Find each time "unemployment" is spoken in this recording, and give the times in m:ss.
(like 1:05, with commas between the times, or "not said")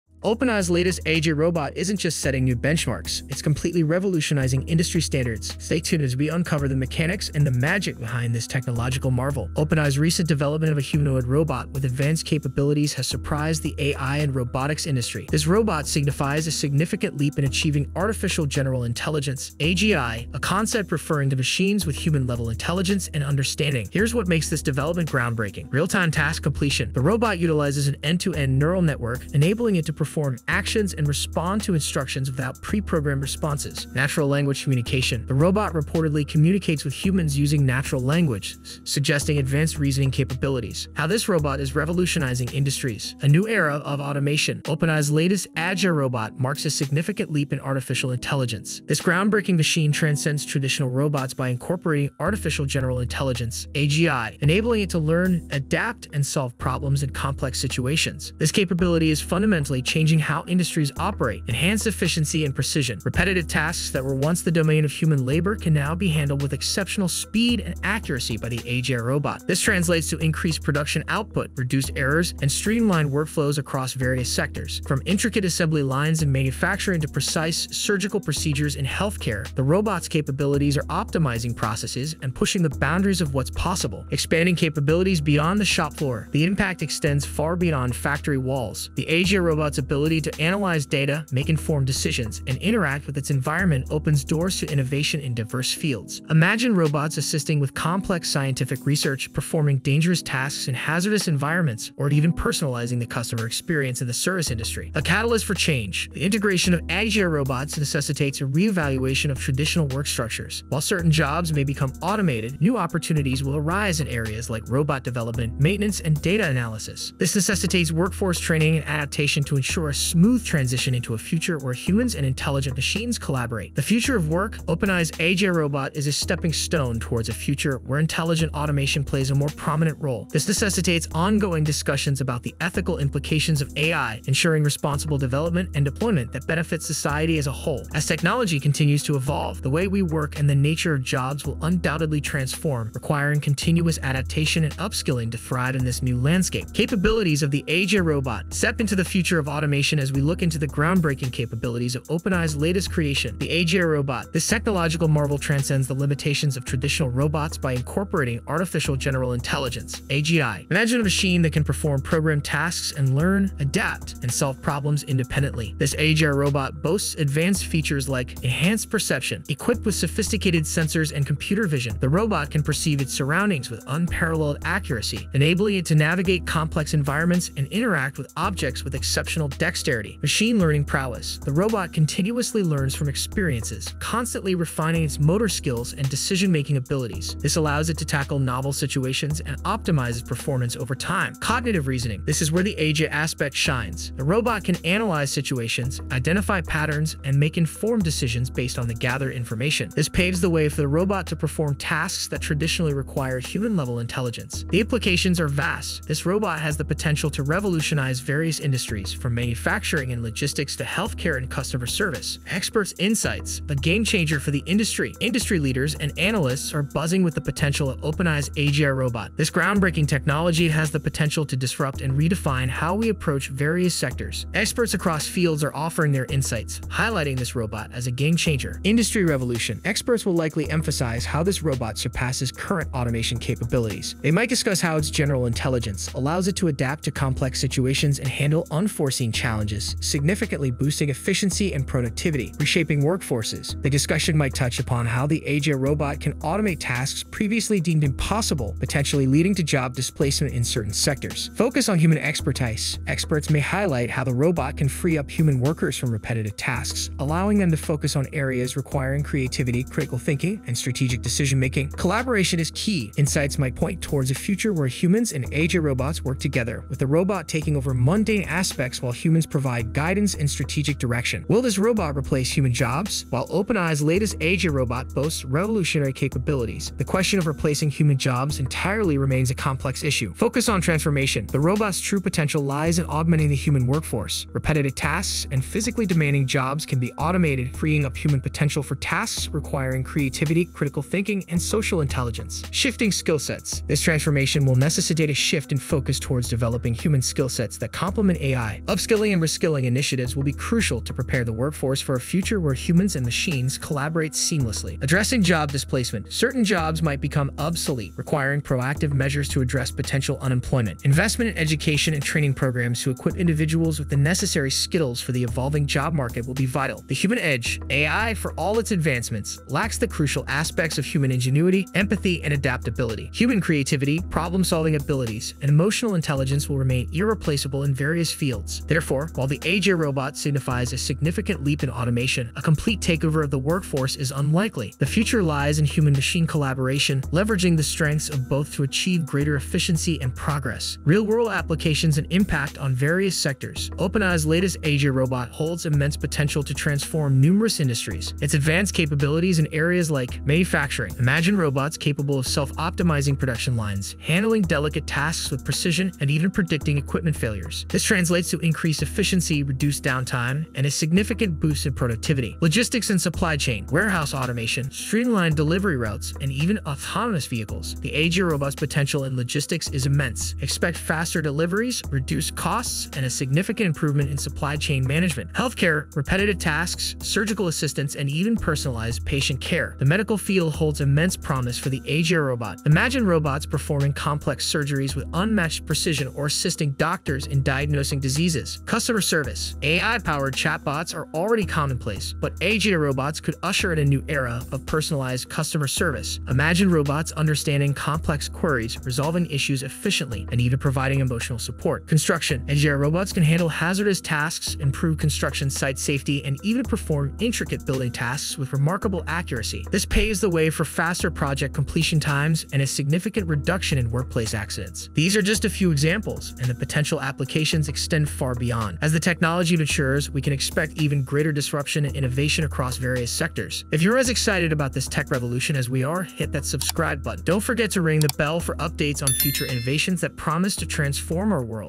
5:10.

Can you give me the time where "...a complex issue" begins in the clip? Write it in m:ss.
4:39.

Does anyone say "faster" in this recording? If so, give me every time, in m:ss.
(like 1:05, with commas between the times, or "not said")
6:10, 6:50.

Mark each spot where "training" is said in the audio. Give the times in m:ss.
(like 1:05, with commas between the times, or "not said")
1:58, 5:12.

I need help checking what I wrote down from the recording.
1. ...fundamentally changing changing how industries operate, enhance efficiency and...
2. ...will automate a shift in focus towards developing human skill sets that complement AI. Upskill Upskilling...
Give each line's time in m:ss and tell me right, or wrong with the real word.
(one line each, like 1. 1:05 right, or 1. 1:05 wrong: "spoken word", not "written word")
1. 0:59 right
2. 4:54 wrong: "necessitate", not "automate".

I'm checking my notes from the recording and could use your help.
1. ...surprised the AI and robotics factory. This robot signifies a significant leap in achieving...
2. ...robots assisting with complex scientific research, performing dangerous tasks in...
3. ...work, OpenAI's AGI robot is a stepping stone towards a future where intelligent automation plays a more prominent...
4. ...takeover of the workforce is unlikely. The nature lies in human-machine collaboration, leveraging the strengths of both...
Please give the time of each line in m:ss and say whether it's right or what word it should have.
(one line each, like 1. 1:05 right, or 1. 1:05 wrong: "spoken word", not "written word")
1. 0:13 wrong: "industry", not "factory"
2. 1:36 right
3. 2:04 right
4. 5:33 wrong: "future", not "nature".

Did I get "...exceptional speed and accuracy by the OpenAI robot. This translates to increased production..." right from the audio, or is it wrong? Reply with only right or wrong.
wrong.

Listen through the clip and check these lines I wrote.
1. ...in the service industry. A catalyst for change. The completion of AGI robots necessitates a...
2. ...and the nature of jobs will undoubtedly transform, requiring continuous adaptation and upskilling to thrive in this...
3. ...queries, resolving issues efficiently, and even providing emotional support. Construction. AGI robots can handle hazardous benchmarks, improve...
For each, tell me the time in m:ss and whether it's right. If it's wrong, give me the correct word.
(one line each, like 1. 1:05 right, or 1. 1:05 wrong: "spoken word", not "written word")
1. 1:43 wrong: "integration", not "completion"
2. 2:20 right
3. 6:38 wrong: "tasks", not "benchmarks".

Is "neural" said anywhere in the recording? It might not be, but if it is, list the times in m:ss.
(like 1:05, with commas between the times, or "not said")
0:28.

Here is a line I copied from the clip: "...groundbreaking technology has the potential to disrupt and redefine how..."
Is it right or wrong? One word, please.
right.